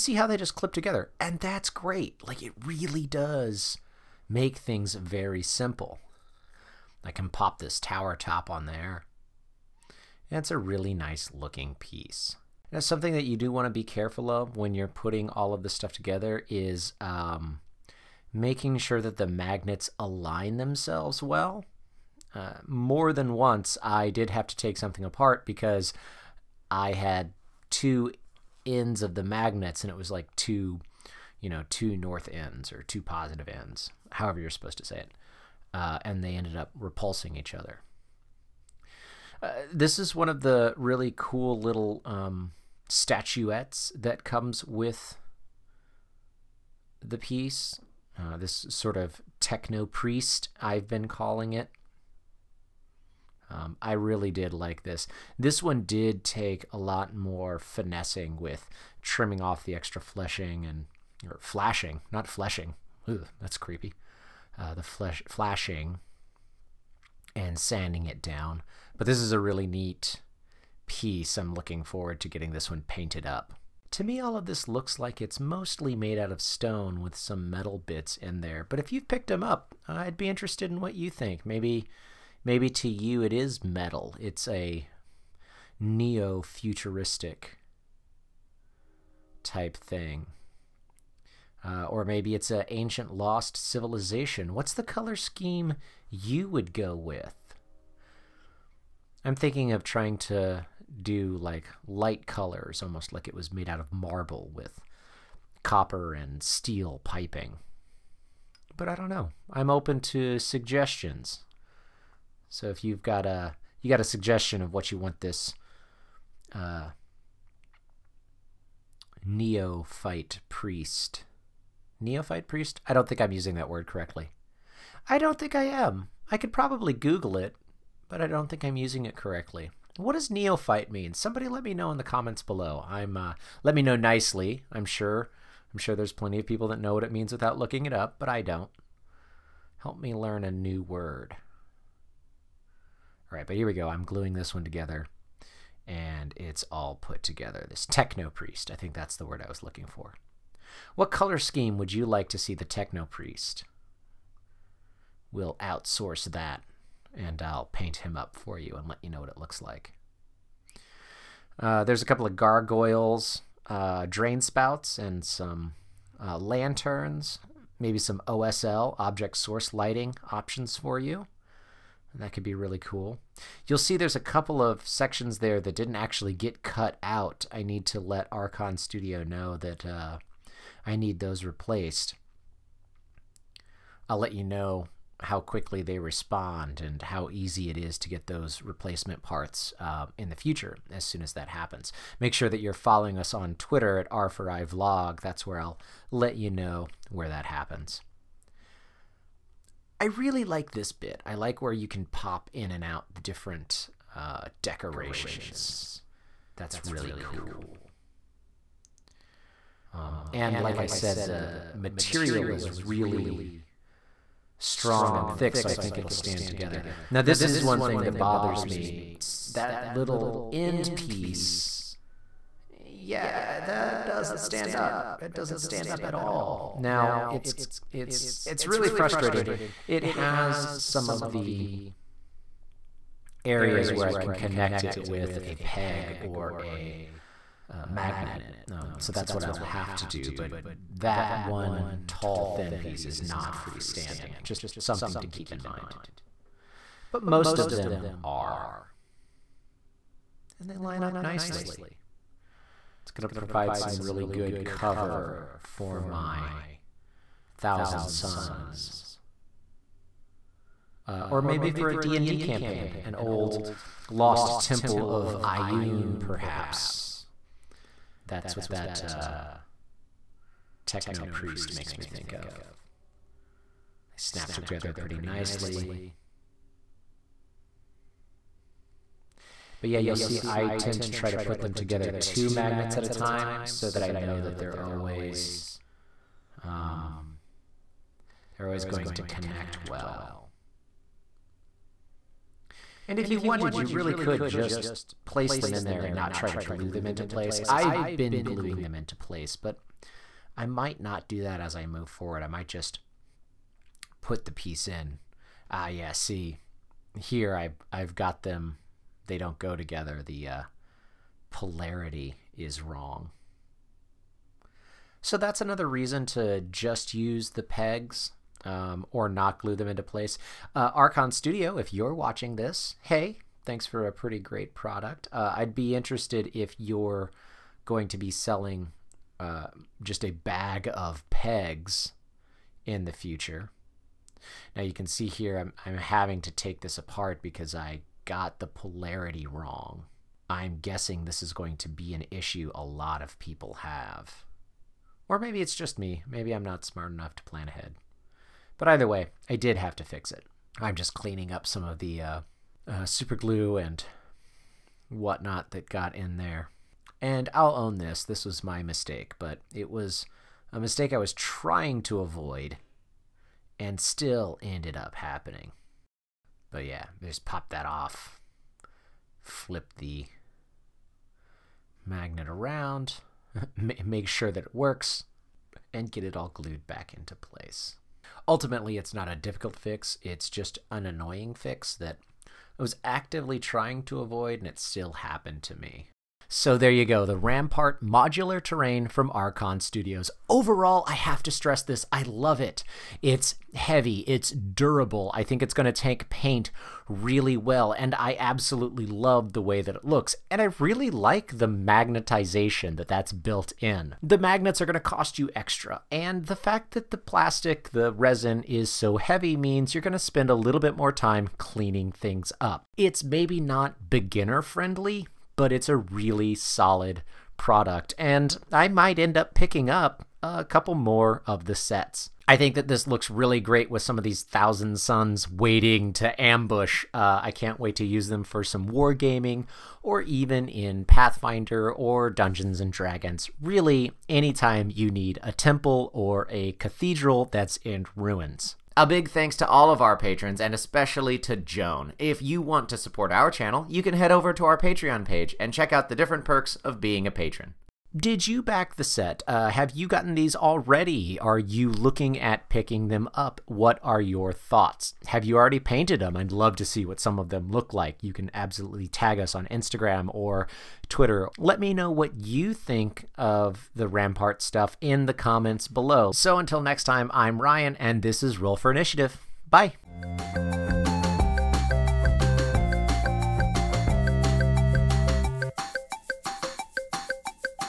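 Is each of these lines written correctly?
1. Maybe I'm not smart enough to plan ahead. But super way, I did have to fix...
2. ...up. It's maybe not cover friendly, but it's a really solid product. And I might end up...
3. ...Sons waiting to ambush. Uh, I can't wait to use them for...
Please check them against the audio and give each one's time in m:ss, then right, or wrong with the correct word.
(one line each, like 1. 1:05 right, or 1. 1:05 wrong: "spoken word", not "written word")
1. 5:46 wrong: "either", not "super"
2. 6:52 wrong: "beginner", not "cover"
3. 7:04 right.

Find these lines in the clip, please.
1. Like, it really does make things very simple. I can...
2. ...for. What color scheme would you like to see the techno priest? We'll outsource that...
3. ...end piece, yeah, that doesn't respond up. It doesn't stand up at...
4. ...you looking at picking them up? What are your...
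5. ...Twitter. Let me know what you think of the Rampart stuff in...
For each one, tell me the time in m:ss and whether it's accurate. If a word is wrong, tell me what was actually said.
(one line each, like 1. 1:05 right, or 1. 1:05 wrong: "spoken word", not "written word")
1. 0:02 right
2. 2:29 right
3. 3:40 wrong: "stand", not "respond"
4. 7:31 right
5. 7:41 right.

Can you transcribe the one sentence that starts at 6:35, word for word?
I think it's going to take paint really well, and I absolutely love the way that it looks.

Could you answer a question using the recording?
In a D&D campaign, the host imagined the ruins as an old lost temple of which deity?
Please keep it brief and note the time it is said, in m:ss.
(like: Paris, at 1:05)
Ioun, at 4:25.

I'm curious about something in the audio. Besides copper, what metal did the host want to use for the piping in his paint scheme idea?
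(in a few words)
steel.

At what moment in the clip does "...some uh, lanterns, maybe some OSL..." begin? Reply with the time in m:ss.
2:45.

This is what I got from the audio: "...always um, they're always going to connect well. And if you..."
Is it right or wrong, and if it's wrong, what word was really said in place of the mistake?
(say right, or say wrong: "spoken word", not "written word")
right.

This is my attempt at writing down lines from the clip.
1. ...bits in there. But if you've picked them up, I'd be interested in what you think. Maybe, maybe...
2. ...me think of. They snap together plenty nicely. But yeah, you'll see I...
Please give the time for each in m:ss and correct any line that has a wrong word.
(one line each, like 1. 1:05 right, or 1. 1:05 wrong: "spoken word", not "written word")
1. 1:17 right
2. 4:31 wrong: "pretty", not "plenty".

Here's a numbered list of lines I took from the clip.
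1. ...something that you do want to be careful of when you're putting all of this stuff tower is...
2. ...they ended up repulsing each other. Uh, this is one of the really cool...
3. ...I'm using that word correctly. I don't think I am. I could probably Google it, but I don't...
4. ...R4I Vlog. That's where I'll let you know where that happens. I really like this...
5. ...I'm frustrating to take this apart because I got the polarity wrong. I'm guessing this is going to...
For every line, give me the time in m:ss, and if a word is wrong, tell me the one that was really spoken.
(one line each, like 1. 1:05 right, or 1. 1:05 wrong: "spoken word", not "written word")
1. 0:12 wrong: "together", not "tower"
2. 0:36 right
3. 2:03 right
4. 3:14 right
5. 5:35 wrong: "having", not "frustrating".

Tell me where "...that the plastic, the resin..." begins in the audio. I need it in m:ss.
6:46.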